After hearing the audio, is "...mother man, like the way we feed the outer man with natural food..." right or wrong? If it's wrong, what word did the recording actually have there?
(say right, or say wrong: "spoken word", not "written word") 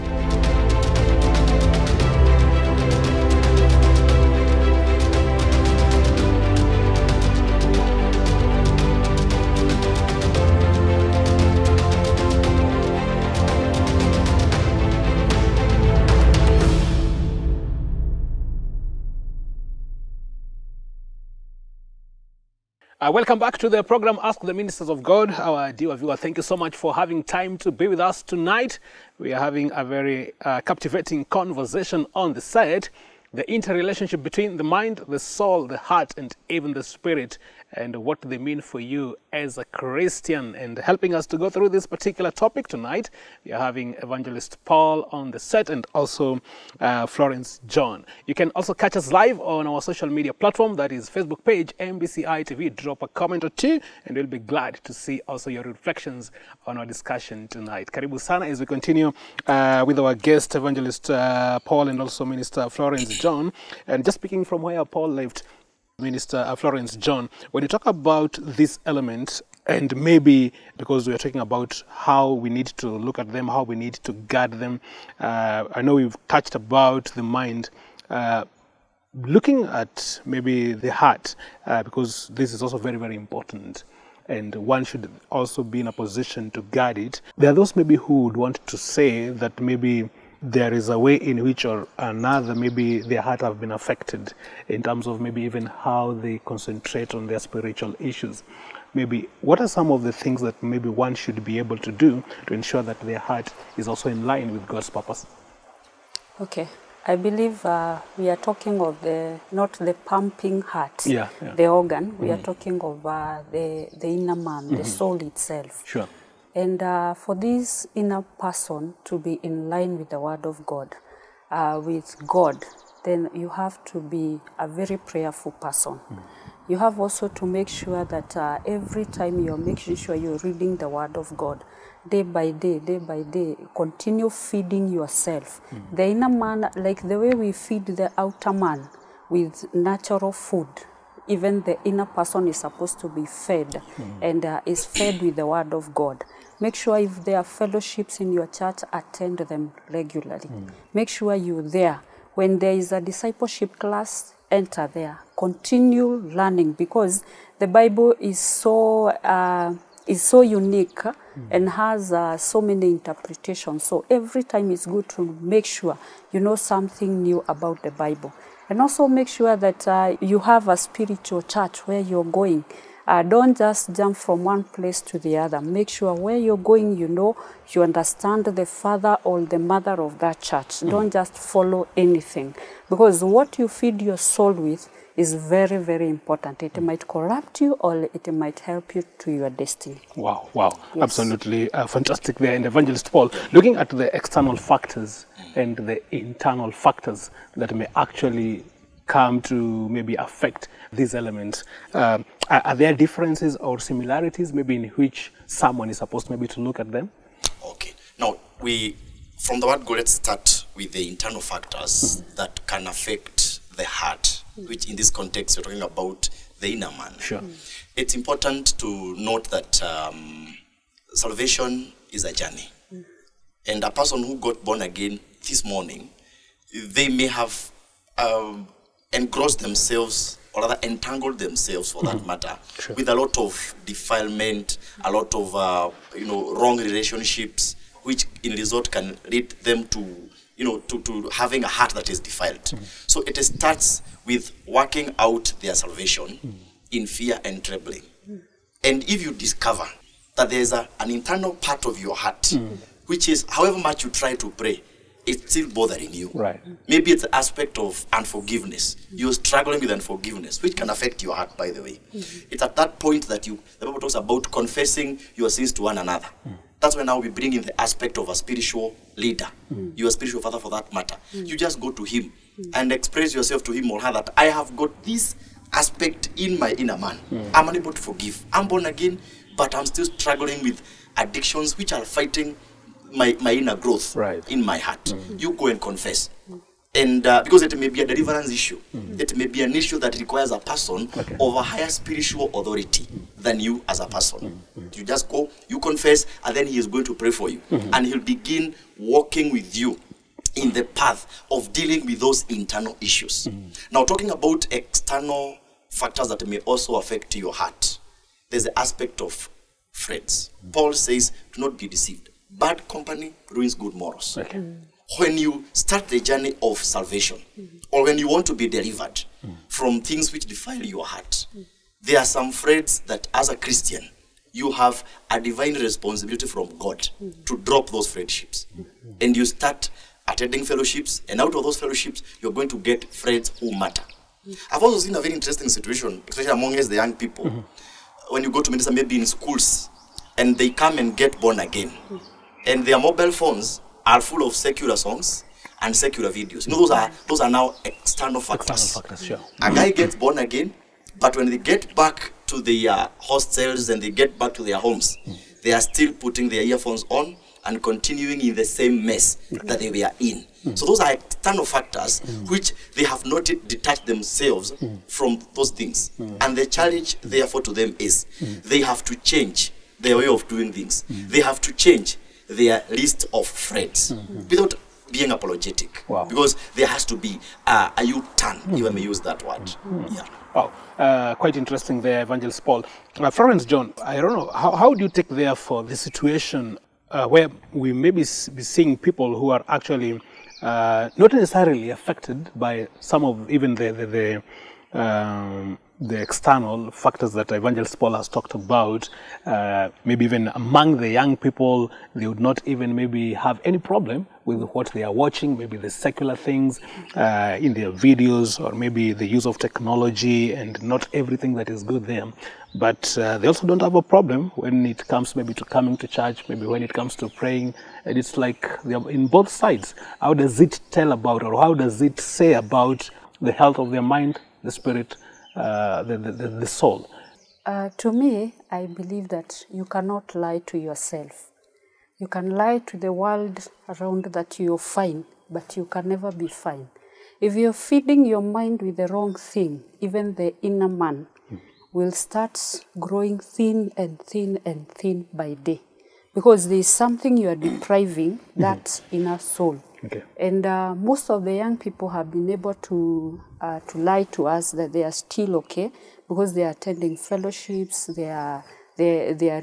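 wrong: "inner", not "mother".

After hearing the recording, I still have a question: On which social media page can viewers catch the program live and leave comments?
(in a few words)
MBCI TV.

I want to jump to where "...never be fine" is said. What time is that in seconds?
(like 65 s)
436 s.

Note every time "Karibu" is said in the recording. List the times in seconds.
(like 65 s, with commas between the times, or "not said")
57 s.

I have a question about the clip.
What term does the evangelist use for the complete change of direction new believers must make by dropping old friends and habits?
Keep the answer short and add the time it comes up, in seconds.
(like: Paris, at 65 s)
U-turn, at 378 s.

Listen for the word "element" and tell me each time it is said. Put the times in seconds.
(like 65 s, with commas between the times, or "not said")
68 s, 201 s.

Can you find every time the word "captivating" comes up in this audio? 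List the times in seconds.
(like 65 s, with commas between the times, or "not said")
30 s.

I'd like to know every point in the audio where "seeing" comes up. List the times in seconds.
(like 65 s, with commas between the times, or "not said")
388 s.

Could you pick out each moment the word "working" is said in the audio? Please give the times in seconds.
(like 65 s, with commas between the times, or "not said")
244 s.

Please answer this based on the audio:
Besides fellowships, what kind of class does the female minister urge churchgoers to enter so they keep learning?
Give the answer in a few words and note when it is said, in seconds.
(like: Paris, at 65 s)
Discipleship class, at 153 s.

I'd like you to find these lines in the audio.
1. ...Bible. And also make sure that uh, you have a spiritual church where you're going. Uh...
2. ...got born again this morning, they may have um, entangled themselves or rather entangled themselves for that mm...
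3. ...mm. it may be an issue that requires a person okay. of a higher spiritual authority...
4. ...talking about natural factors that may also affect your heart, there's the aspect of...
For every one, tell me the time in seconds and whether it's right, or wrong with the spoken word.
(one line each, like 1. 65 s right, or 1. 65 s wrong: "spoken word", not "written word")
1. 167 s right
2. 224 s wrong: "engrossed", not "entangled"
3. 288 s right
4. 304 s wrong: "external", not "natural".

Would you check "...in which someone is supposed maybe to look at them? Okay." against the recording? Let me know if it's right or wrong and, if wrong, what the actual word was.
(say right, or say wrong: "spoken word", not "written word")
right.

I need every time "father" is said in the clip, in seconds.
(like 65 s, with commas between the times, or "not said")
178 s, 270 s.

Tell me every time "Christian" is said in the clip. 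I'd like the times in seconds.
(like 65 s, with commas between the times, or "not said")
39 s, 323 s.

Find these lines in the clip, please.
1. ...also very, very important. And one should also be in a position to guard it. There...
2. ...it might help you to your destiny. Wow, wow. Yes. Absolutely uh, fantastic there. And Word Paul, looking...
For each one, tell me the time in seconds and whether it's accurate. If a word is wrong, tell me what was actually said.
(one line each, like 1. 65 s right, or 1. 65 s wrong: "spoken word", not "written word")
1. 82 s right
2. 188 s wrong: "Evangelist", not "Word".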